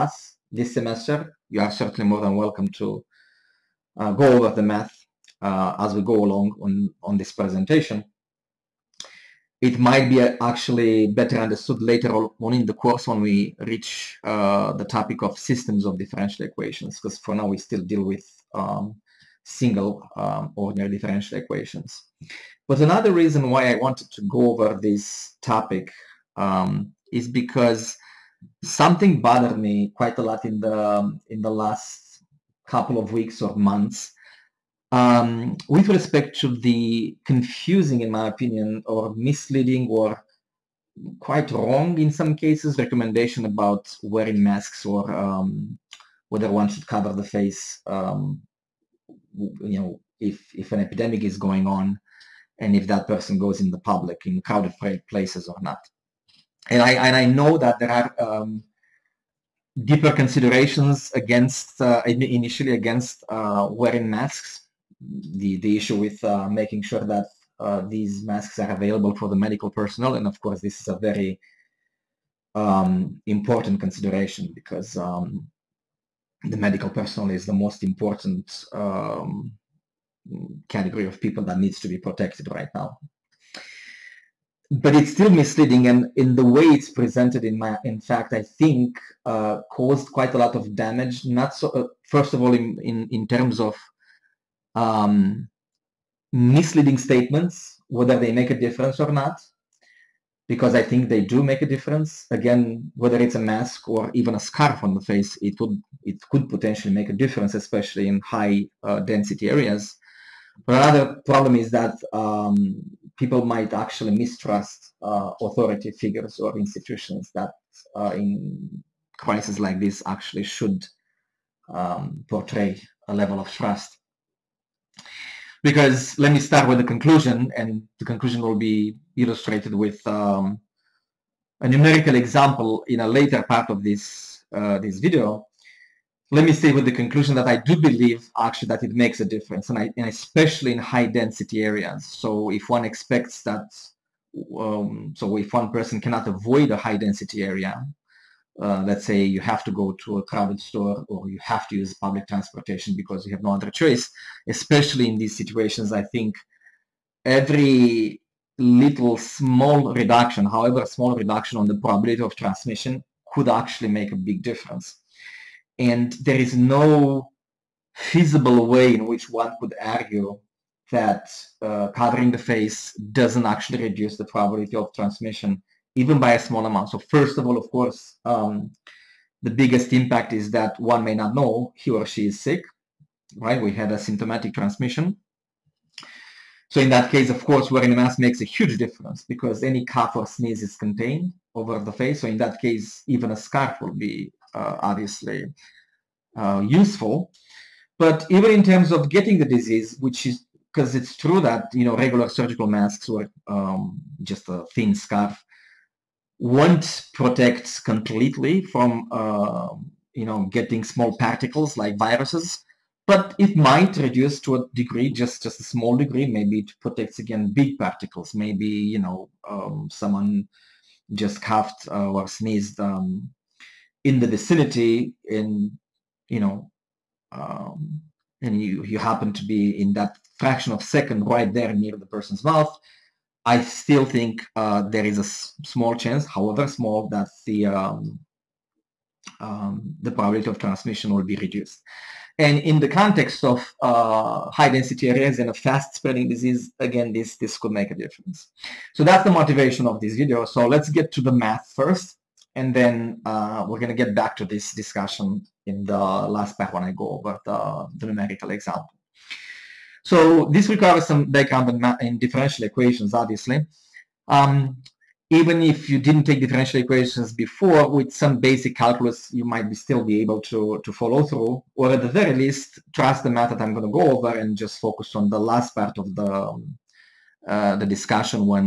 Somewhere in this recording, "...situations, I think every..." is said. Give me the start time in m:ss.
2:35.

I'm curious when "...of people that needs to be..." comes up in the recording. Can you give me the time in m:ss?
1:21.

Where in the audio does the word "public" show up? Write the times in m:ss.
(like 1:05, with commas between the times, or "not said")
0:53, 2:31.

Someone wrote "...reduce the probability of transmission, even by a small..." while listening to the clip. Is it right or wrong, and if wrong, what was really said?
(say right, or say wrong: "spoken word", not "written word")
right.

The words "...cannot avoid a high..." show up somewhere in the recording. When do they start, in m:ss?
2:26.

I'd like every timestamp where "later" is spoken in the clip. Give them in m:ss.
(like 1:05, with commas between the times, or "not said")
0:11, 2:13.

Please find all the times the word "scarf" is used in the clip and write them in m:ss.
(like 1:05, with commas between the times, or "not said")
1:44, 3:13, 3:24.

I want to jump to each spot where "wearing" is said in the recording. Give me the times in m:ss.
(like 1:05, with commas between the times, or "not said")
0:44, 1:03, 3:07.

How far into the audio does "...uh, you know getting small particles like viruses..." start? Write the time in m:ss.
3:29.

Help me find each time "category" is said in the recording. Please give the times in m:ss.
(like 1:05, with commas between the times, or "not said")
1:20.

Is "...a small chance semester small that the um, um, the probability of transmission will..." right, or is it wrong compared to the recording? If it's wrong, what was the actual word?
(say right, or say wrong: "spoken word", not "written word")
wrong: "however", not "semester".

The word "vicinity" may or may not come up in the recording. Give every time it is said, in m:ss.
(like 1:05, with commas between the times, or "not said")
3:44.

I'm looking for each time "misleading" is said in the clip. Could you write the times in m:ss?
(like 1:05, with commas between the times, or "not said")
0:39, 1:25, 1:36.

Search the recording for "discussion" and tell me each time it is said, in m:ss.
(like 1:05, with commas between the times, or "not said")
4:14, 4:37.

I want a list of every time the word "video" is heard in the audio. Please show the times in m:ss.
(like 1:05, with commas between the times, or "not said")
2:14, 4:10.